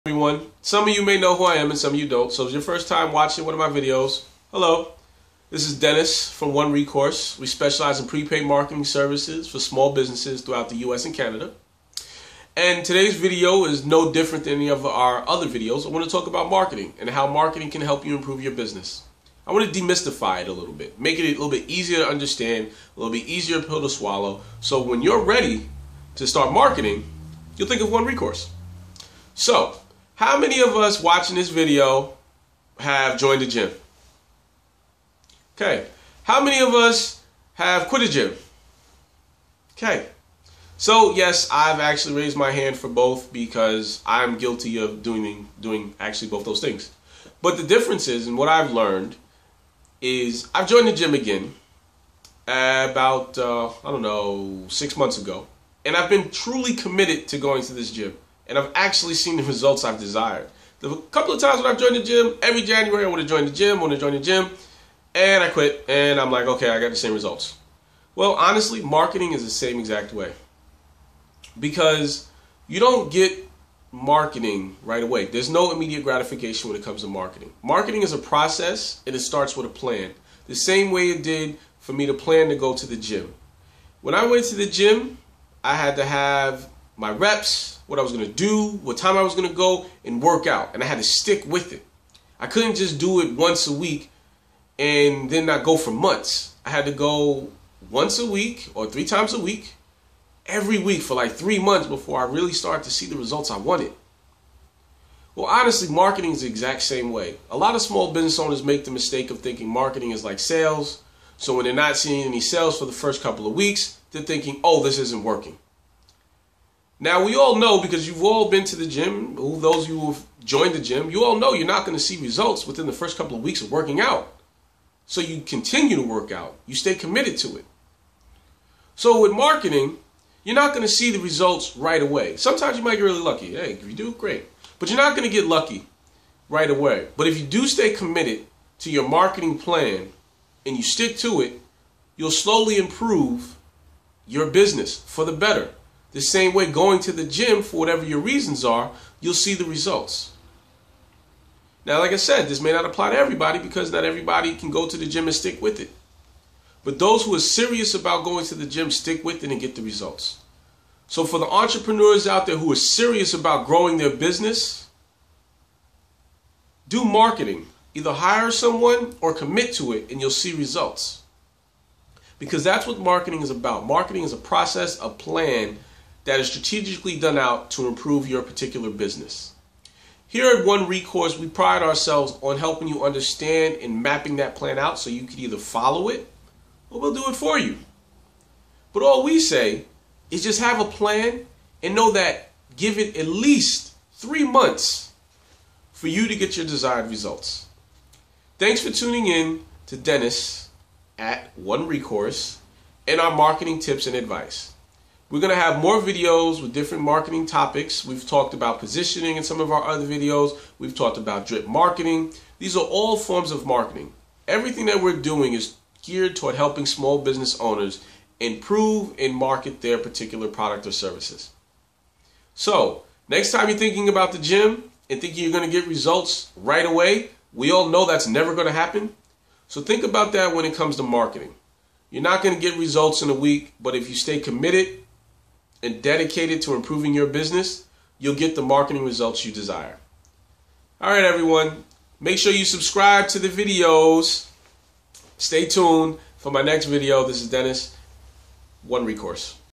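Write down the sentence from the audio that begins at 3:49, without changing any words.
So, think about that when it comes to marketing.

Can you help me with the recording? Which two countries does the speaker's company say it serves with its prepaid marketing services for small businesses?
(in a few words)
US and Canada.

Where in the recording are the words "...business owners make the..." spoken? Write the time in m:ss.
1:48.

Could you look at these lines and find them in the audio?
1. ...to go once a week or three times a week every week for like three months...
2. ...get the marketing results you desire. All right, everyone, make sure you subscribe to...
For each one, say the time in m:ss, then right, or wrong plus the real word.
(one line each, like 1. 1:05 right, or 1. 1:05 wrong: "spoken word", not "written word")
1. 1:36 right
2. 3:58 right.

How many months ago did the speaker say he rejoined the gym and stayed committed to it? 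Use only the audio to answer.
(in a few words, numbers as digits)
6.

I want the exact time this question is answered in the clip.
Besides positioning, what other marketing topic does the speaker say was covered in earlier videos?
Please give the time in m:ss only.
3:31.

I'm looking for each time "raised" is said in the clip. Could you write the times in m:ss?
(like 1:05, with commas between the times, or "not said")
0:42.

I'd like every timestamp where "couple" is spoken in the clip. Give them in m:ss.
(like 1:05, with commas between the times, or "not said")
1:01, 1:53, 2:03.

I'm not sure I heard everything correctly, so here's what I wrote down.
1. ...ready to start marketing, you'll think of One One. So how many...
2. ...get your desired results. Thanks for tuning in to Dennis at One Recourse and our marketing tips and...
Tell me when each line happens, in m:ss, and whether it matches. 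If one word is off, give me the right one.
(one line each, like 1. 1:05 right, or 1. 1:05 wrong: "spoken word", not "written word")
1. 0:25 wrong: "Recourse", not "One"
2. 3:16 right.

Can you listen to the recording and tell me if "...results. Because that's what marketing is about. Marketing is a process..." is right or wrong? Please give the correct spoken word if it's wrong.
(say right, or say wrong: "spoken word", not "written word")
right.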